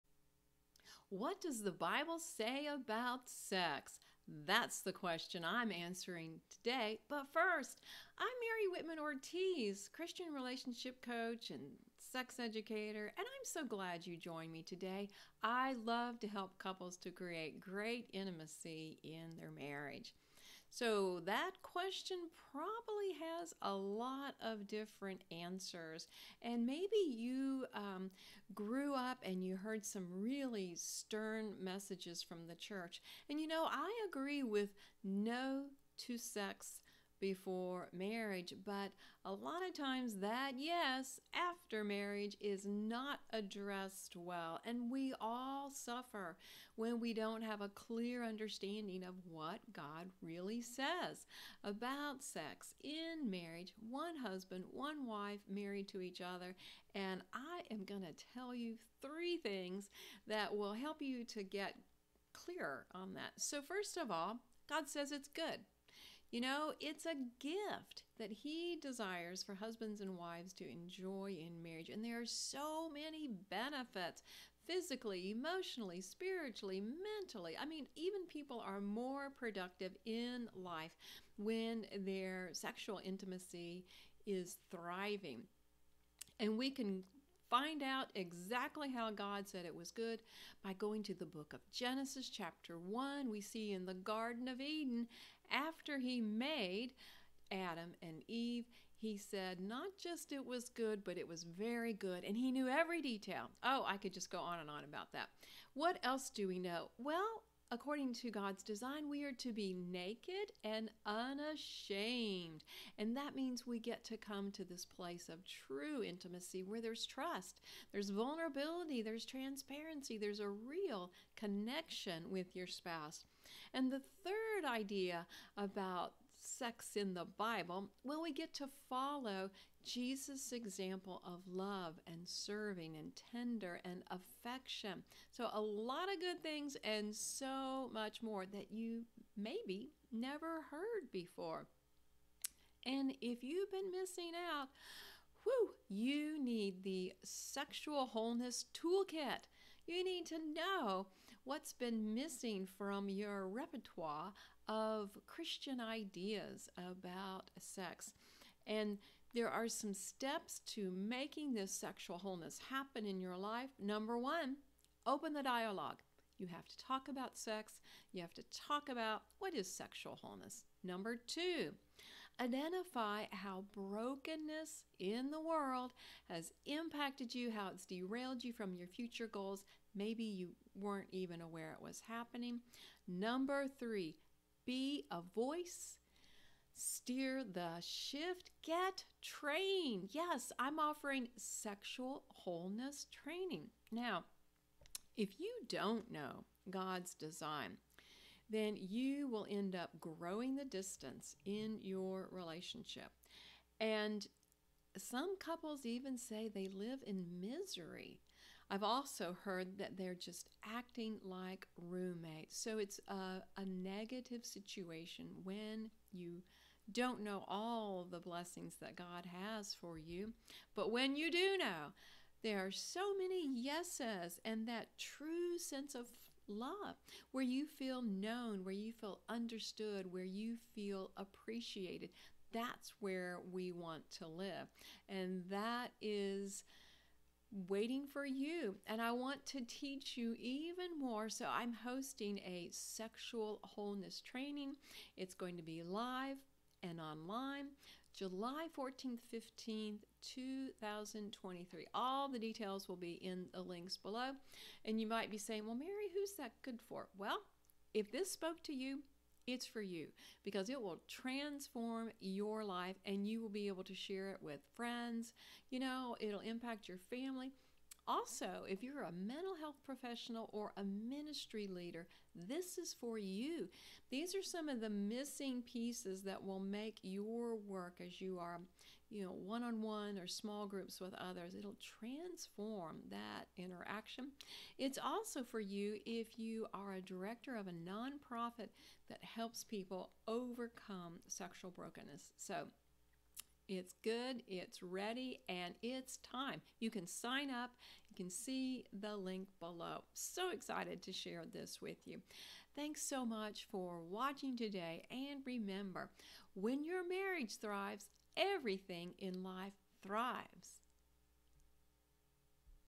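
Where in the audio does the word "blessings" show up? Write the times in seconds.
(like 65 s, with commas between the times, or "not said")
218 s.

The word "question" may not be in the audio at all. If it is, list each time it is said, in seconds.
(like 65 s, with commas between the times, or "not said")
4 s, 21 s.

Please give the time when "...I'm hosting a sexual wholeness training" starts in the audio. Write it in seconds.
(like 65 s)
241 s.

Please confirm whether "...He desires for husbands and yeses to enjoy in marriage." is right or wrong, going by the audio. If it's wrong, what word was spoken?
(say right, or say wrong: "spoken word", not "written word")
wrong: "wives", not "yeses".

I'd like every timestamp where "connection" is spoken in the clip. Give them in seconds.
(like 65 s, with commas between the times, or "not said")
121 s.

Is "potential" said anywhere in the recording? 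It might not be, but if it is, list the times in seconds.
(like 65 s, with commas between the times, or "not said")
not said.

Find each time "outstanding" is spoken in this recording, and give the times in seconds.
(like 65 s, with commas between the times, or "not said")
not said.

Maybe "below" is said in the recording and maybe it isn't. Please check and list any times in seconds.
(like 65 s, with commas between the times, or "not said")
253 s, 299 s.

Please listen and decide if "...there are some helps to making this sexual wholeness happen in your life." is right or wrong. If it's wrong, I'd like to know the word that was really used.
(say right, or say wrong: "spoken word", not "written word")
wrong: "steps", not "helps".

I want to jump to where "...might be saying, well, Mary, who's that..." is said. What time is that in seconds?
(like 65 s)
255 s.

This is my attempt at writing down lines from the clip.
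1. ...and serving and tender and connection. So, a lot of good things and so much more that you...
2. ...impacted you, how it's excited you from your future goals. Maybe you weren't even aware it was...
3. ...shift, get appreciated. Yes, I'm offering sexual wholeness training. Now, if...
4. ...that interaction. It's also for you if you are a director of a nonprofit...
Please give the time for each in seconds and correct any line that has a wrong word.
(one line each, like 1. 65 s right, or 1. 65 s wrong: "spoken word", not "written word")
1. 132 s wrong: "affection", not "connection"
2. 176 s wrong: "derailed", not "excited"
3. 187 s wrong: "trained", not "appreciated"
4. 283 s right.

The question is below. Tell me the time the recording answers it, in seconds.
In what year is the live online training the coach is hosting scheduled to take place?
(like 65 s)
250 s.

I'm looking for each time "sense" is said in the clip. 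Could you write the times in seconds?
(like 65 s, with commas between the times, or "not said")
225 s.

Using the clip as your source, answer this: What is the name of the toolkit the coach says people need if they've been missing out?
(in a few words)
sexual wholeness toolkit.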